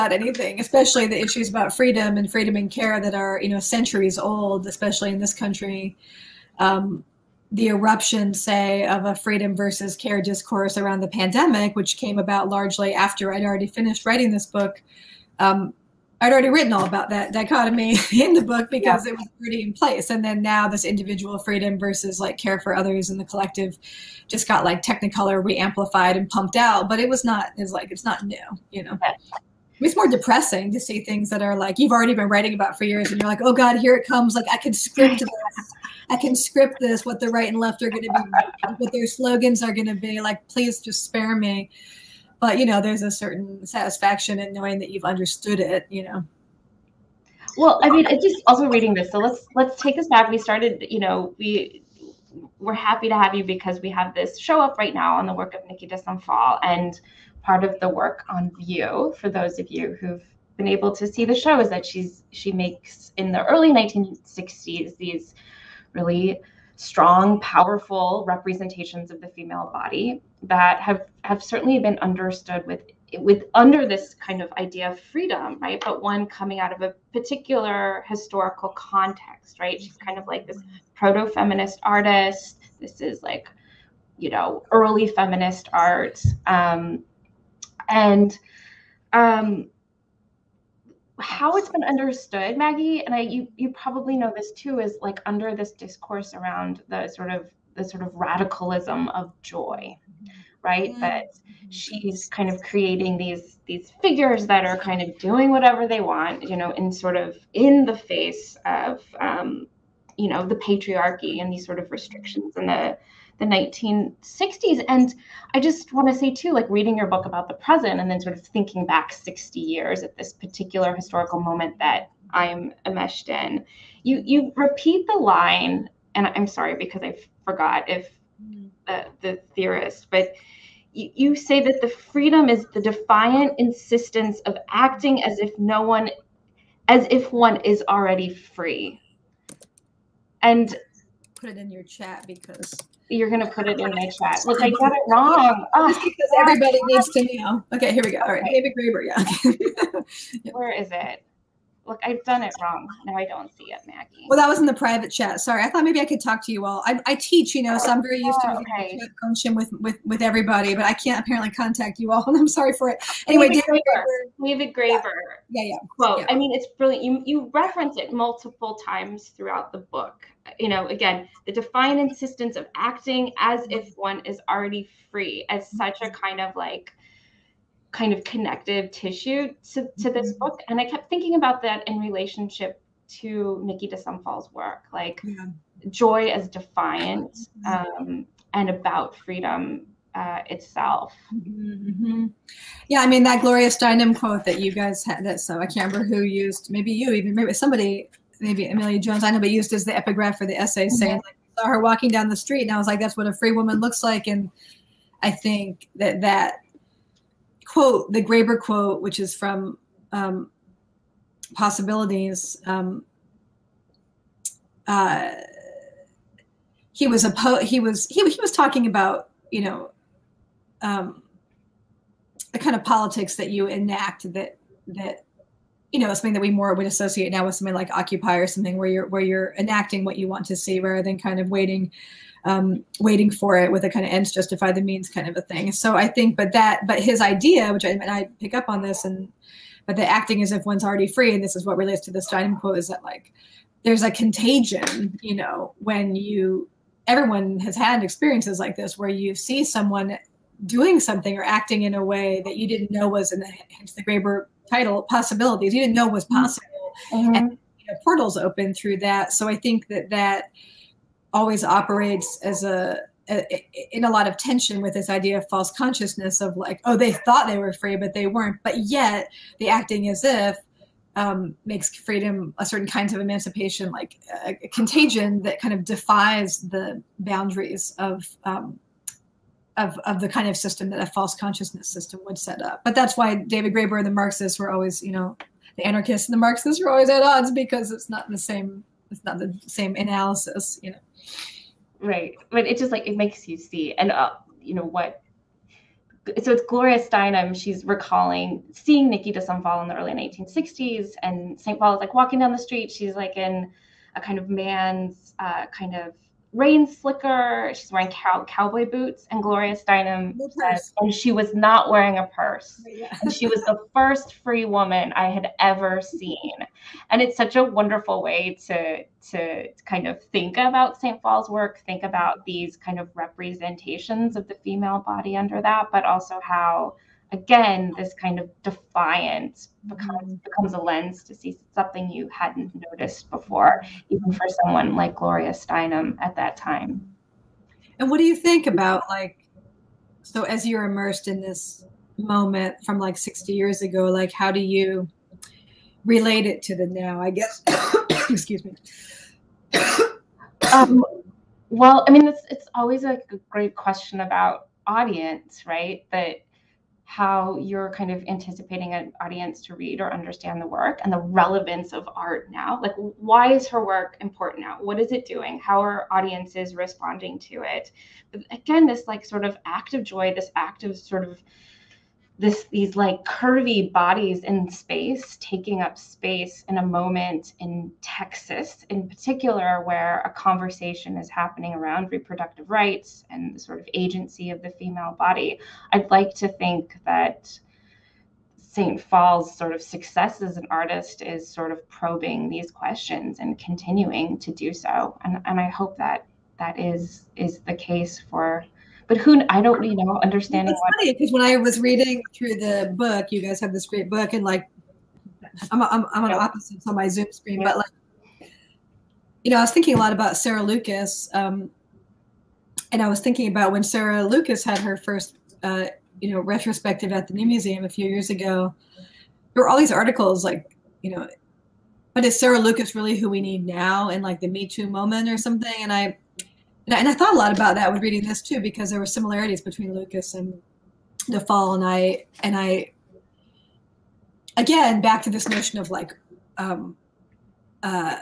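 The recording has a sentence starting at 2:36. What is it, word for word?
I, I teach, you know, so I'm very used oh, to okay.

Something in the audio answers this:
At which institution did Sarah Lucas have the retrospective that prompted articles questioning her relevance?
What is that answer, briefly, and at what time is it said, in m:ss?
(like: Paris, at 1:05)
New Museum, at 6:57.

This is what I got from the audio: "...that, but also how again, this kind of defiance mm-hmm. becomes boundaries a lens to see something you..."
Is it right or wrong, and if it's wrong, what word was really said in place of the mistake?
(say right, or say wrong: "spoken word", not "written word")
wrong: "becomes", not "boundaries".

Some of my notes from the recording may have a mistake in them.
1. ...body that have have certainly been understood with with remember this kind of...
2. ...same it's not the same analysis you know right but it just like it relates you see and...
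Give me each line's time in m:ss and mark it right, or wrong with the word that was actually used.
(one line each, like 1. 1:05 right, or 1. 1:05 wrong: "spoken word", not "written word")
1. 1:09 wrong: "under", not "remember"
2. 4:48 wrong: "makes", not "relates".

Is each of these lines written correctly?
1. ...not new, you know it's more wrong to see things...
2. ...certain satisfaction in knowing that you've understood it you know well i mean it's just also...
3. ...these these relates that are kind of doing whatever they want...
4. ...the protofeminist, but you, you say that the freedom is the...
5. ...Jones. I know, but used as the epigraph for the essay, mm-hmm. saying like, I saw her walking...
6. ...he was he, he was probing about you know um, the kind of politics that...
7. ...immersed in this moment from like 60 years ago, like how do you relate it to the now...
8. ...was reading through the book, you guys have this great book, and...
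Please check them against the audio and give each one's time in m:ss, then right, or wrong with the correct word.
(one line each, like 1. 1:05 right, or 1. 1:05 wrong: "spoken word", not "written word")
1. 0:28 wrong: "depressing", not "wrong"
2. 0:43 right
3. 1:43 wrong: "figures", not "relates"
4. 2:09 wrong: "theorist", not "protofeminist"
5. 3:18 right
6. 3:37 wrong: "talking", not "probing"
7. 5:40 right
8. 6:41 right.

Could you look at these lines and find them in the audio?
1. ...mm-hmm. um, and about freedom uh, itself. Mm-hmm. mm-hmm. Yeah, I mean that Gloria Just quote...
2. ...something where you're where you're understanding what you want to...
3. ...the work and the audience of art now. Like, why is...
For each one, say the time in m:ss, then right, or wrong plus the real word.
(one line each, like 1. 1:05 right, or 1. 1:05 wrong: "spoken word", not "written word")
1. 3:07 wrong: "Steinem", not "Just"
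2. 3:48 wrong: "enacting", not "understanding"
3. 6:00 wrong: "relevance", not "audience".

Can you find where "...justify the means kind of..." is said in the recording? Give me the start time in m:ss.
3:54.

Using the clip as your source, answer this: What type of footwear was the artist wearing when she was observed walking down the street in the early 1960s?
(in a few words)
Cowboy boots.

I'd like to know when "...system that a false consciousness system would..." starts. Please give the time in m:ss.
4:40.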